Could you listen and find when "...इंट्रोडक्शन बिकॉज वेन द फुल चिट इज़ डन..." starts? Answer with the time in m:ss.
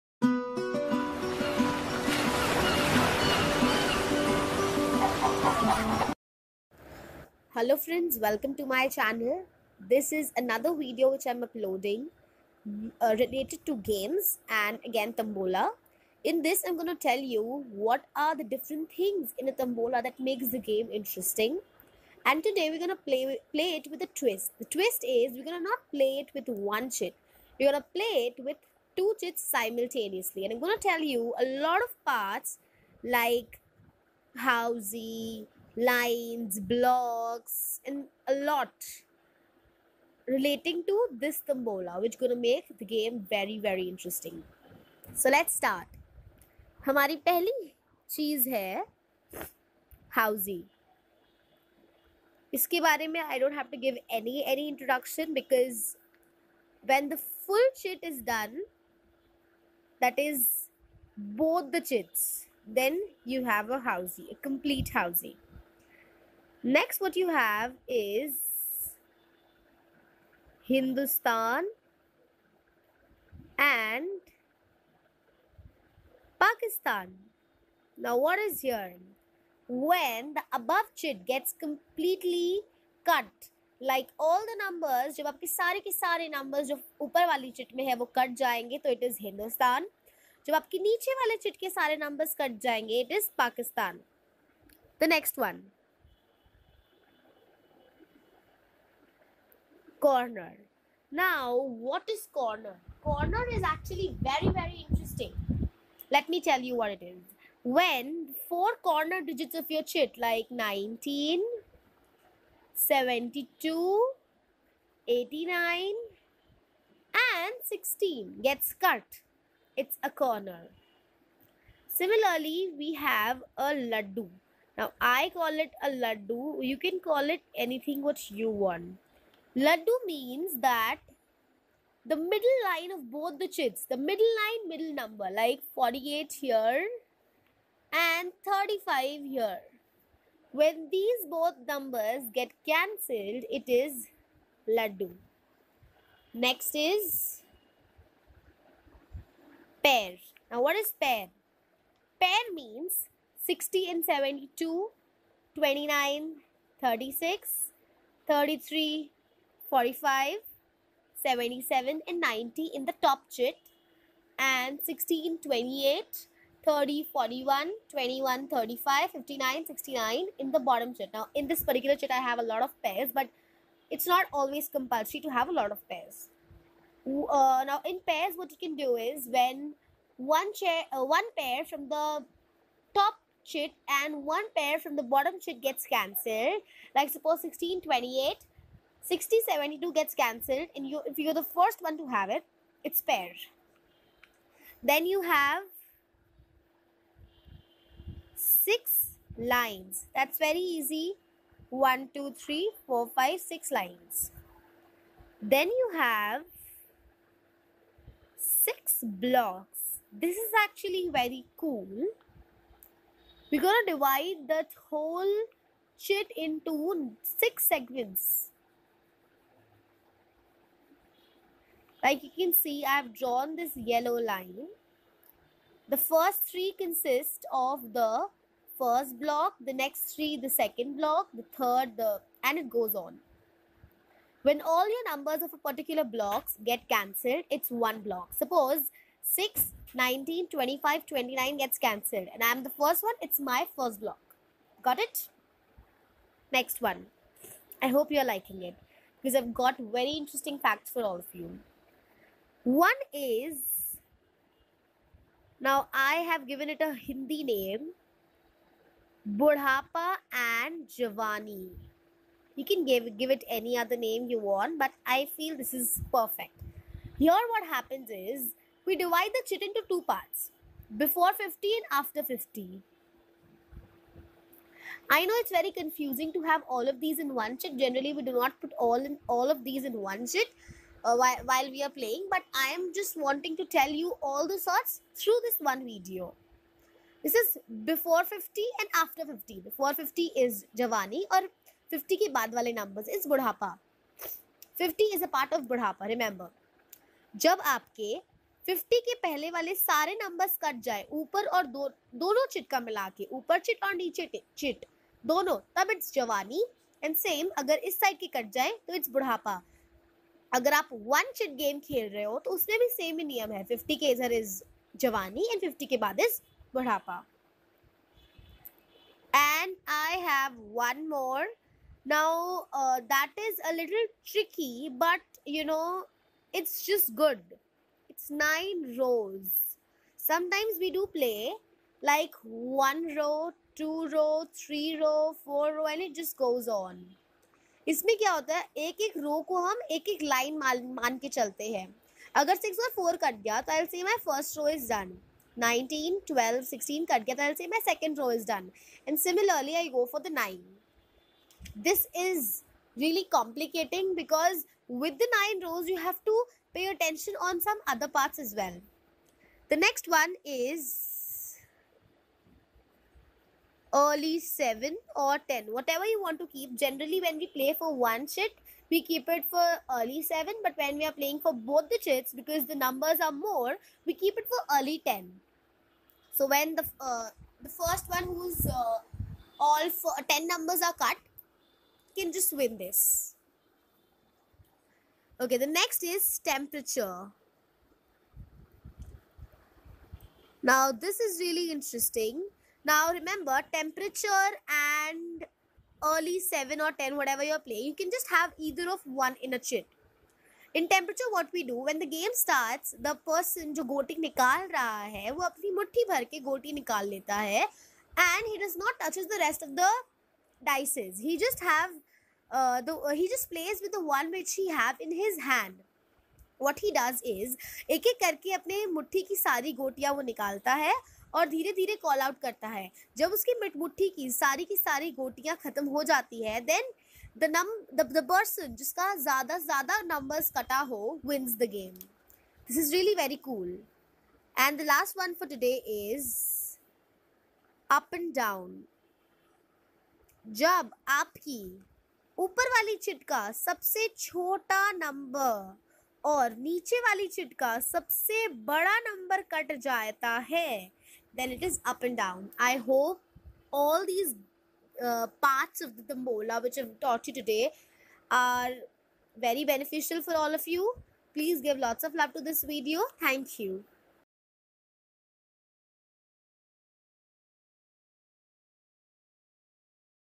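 0:54.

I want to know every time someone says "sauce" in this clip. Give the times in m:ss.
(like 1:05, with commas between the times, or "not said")
not said.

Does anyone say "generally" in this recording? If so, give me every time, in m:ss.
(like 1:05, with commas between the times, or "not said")
4:37, 6:06.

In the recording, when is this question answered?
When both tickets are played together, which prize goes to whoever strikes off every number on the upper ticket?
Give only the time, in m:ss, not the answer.
1:29.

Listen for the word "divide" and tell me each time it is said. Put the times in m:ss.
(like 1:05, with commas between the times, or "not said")
3:33, 4:28.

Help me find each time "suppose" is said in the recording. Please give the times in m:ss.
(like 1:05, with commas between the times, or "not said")
3:07, 3:58.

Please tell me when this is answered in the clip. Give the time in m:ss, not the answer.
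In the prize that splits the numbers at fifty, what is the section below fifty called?
4:50.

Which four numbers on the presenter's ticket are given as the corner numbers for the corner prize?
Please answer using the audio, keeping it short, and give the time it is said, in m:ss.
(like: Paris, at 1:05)
19, 72, 89 and 16, at 1:50.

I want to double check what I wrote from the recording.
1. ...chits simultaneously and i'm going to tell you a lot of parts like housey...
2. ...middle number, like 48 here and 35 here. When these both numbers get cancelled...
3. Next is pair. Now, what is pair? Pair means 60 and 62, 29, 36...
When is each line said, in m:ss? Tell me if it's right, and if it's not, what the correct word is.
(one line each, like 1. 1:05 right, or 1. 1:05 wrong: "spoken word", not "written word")
1. 0:29 right
2. 2:14 right
3. 2:26 wrong: "72", not "62".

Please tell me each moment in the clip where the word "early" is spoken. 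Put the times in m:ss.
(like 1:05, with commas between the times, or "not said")
6:03, 6:09, 6:14, 6:36.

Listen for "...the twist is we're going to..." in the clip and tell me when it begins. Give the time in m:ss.
0:24.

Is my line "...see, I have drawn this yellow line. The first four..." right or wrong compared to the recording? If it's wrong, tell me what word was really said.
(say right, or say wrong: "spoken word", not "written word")
wrong: "three", not "four".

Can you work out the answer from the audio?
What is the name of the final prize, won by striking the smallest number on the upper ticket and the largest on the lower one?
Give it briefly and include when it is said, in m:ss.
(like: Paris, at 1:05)
Up and down, at 7:17.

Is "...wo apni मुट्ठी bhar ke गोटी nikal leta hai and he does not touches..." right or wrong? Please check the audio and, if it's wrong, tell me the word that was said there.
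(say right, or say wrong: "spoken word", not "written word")
right.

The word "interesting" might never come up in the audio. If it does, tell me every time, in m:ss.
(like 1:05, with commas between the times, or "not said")
0:21, 0:43, 1:44, 4:10, 6:31.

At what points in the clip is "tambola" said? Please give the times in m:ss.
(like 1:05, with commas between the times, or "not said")
0:15, 0:19, 7:36.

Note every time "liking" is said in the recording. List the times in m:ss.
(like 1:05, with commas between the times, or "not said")
4:08.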